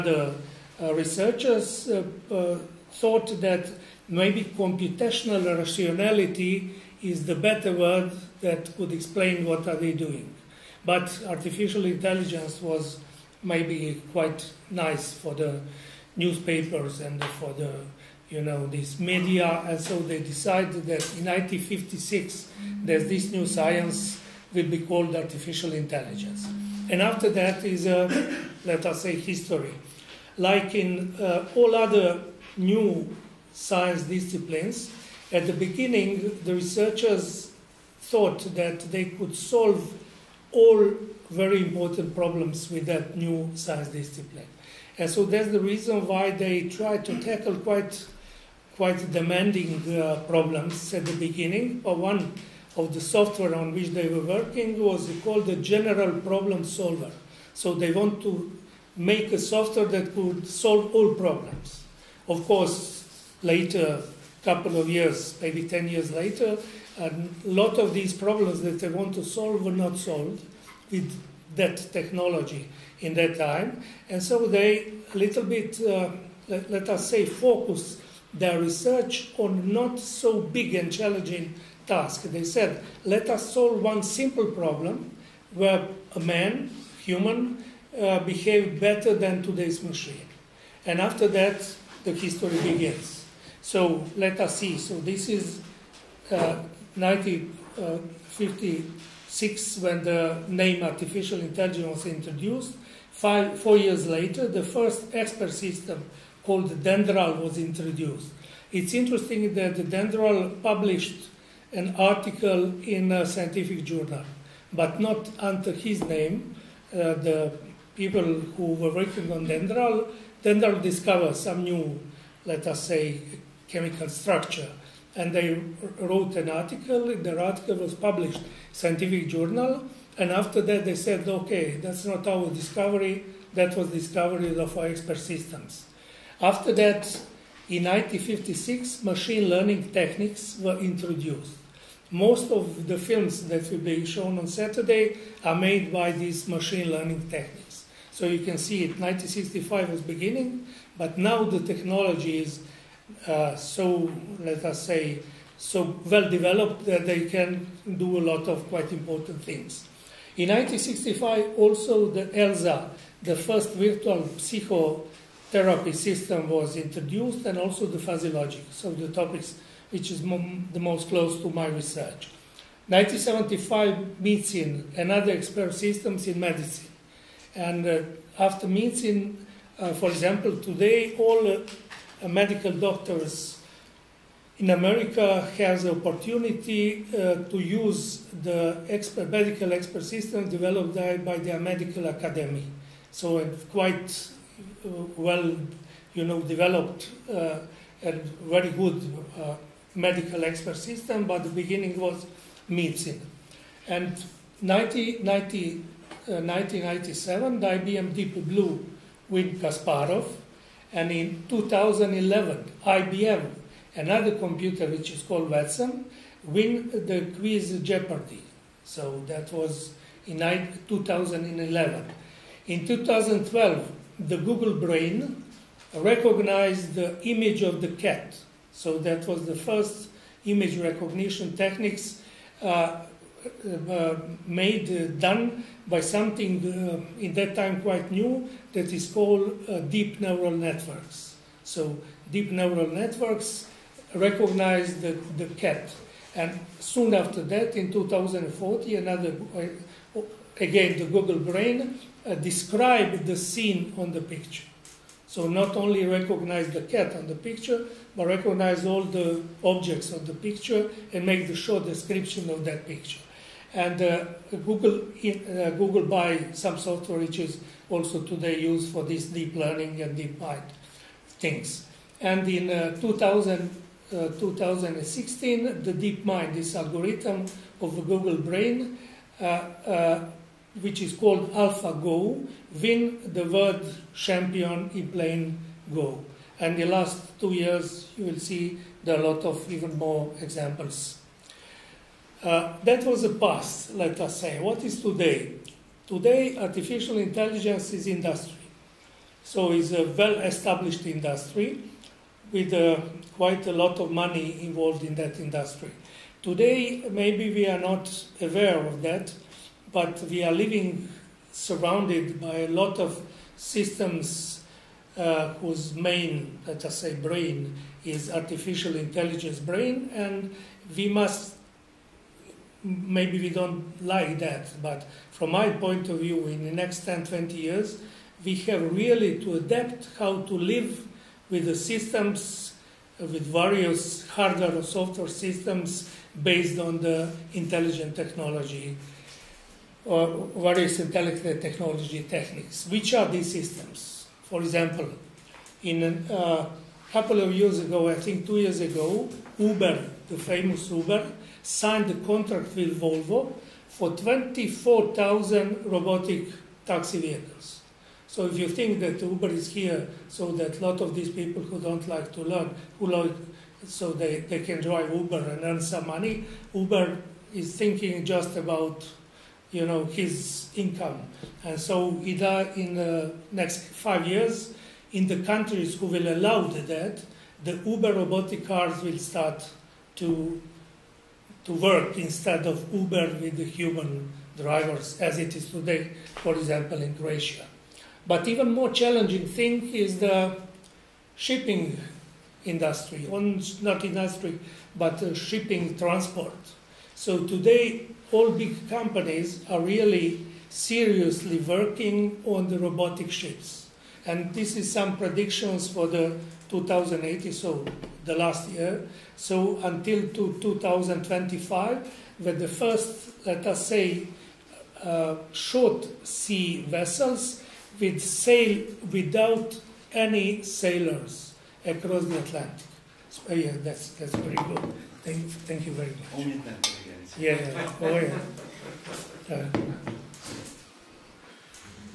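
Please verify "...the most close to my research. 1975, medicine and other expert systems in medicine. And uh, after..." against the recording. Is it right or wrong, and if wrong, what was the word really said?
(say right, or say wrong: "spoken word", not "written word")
right.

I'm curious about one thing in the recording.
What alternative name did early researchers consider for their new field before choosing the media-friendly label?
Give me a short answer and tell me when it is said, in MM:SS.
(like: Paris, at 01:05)
computational rationality, at 00:04.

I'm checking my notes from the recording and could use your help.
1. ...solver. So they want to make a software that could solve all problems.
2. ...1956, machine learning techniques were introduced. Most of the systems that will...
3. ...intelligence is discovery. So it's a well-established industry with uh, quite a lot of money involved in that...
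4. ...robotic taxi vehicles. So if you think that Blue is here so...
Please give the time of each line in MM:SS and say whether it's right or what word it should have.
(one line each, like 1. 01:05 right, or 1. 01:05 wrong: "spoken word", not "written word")
1. 00:56 right
2. 02:17 wrong: "films", not "systems"
3. 04:57 wrong: "industry", not "discovery"
4. 05:55 wrong: "Uber", not "Blue".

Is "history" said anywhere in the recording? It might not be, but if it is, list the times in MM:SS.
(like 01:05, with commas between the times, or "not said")
00:29, 01:32.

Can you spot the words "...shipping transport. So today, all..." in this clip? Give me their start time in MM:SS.
06:35.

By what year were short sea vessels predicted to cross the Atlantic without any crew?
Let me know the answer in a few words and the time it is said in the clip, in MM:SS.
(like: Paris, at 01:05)
2025, at 06:50.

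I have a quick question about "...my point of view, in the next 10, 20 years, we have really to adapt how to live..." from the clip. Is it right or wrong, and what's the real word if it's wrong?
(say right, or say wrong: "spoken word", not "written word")
right.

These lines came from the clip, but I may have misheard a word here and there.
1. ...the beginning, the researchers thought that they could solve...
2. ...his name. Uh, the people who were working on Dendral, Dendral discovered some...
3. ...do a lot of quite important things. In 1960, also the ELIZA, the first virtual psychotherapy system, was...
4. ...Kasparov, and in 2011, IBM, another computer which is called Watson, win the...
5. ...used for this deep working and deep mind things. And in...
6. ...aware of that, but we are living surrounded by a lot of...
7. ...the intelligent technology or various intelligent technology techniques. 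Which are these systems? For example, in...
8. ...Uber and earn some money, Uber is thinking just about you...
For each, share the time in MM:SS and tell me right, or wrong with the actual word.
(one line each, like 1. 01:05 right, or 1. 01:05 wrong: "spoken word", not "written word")
1. 00:35 right
2. 01:55 right
3. 02:37 wrong: "1965", not "1960"
4. 03:29 right
5. 04:28 wrong: "learning", not "working"
6. 05:08 right
7. 05:36 right
8. 06:05 right.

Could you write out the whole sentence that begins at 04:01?
So deep neural networks recognized the, the cat.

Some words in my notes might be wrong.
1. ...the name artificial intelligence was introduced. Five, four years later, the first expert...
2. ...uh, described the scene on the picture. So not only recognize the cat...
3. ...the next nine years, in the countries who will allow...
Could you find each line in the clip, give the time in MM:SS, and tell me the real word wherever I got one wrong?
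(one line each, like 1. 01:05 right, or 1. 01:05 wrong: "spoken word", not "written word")
1. 01:40 right
2. 04:12 right
3. 06:12 wrong: "five", not "nine".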